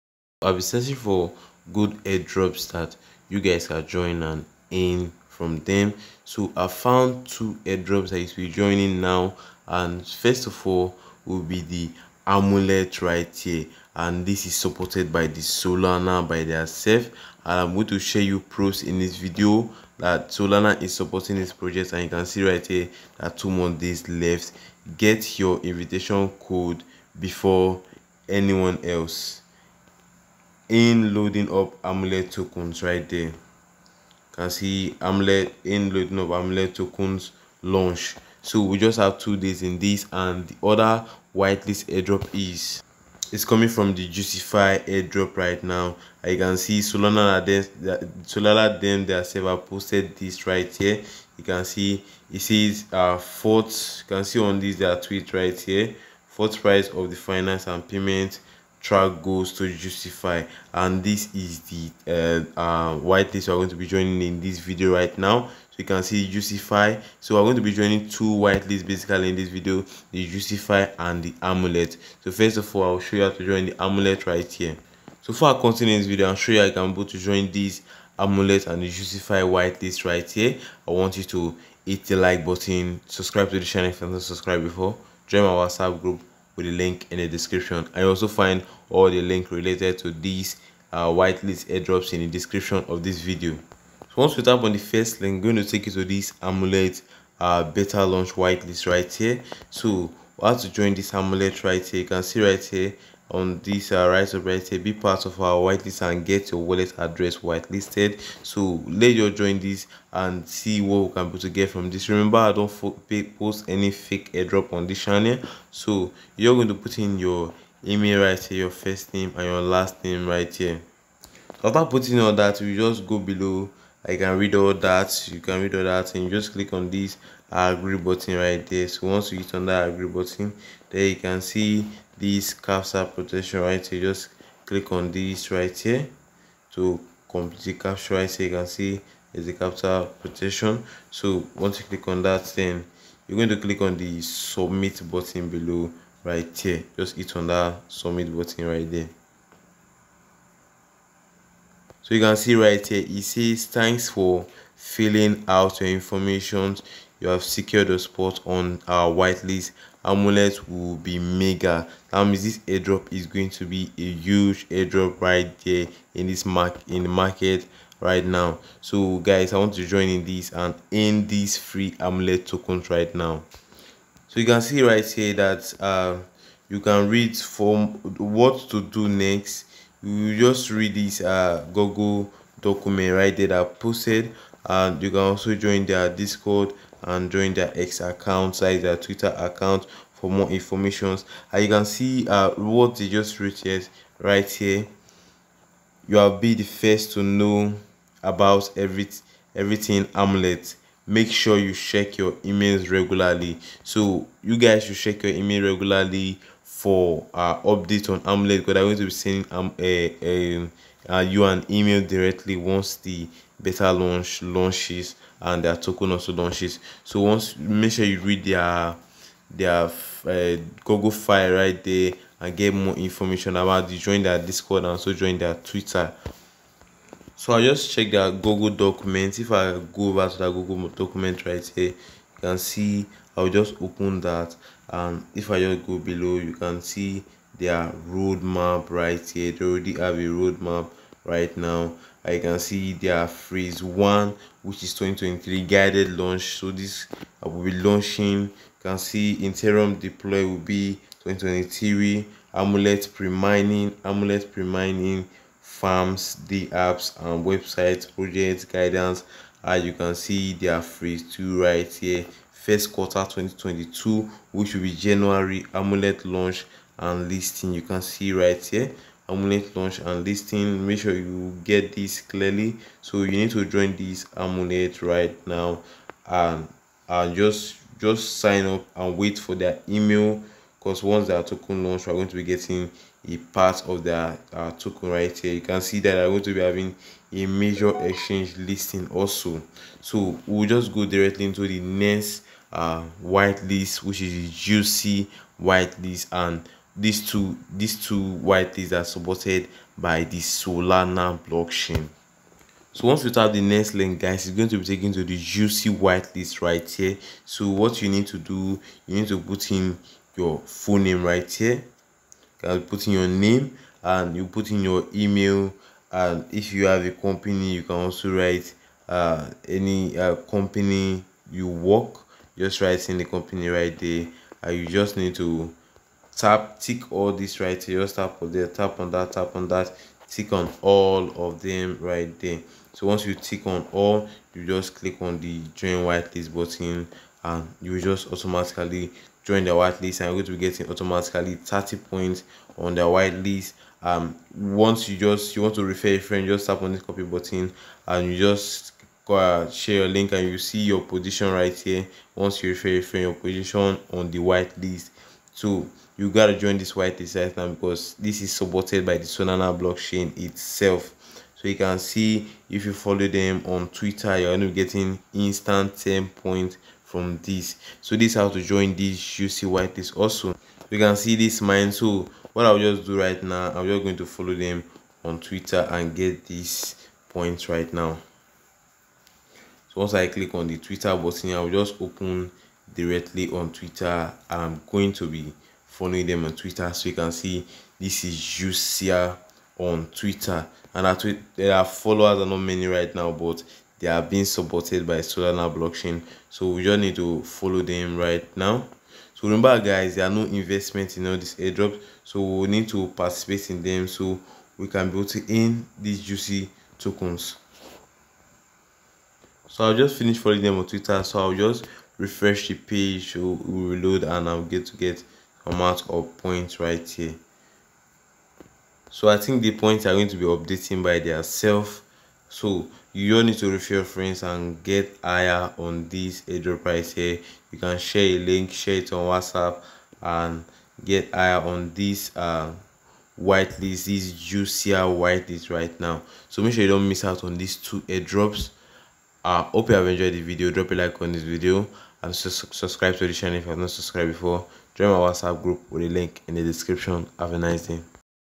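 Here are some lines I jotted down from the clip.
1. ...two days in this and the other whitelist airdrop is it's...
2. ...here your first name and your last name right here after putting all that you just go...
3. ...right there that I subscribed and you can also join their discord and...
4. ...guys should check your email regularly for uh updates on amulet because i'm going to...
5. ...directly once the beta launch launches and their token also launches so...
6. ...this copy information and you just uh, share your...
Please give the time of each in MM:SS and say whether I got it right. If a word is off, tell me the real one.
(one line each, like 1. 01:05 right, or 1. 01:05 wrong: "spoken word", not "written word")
1. 00:39 right
2. 01:58 right
3. 03:03 wrong: "posted", not "subscribed"
4. 03:24 right
5. 03:32 right
6. 05:46 wrong: "button", not "information".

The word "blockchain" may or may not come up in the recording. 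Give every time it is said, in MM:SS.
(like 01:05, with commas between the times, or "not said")
05:01, 05:59, 06:35.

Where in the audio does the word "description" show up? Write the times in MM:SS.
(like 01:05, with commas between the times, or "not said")
01:27, 01:32, 07:26.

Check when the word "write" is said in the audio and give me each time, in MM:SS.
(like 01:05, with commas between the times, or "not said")
05:18, 05:22.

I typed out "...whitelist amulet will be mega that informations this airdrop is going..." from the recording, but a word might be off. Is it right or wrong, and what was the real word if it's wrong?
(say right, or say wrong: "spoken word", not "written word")
wrong: "means", not "informations".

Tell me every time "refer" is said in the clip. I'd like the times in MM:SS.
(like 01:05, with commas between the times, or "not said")
05:45, 05:52, 07:03.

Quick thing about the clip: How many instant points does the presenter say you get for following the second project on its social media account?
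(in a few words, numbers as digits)
10.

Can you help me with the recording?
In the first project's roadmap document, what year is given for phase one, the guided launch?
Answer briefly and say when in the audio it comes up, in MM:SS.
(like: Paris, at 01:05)
2023, at 04:04.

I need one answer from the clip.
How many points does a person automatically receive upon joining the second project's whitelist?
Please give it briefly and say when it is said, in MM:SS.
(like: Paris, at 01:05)
30, at 05:41.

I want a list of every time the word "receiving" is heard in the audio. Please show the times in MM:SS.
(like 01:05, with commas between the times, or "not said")
not said.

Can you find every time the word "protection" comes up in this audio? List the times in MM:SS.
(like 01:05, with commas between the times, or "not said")
02:13, 02:20.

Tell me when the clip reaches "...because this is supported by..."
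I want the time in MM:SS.
05:57.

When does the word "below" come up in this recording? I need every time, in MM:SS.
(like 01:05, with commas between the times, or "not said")
02:03, 02:25, 03:55.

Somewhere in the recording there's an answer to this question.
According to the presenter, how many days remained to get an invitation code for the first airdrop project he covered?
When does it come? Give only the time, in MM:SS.
00:23.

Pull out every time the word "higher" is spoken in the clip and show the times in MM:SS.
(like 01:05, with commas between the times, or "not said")
07:05, 07:11.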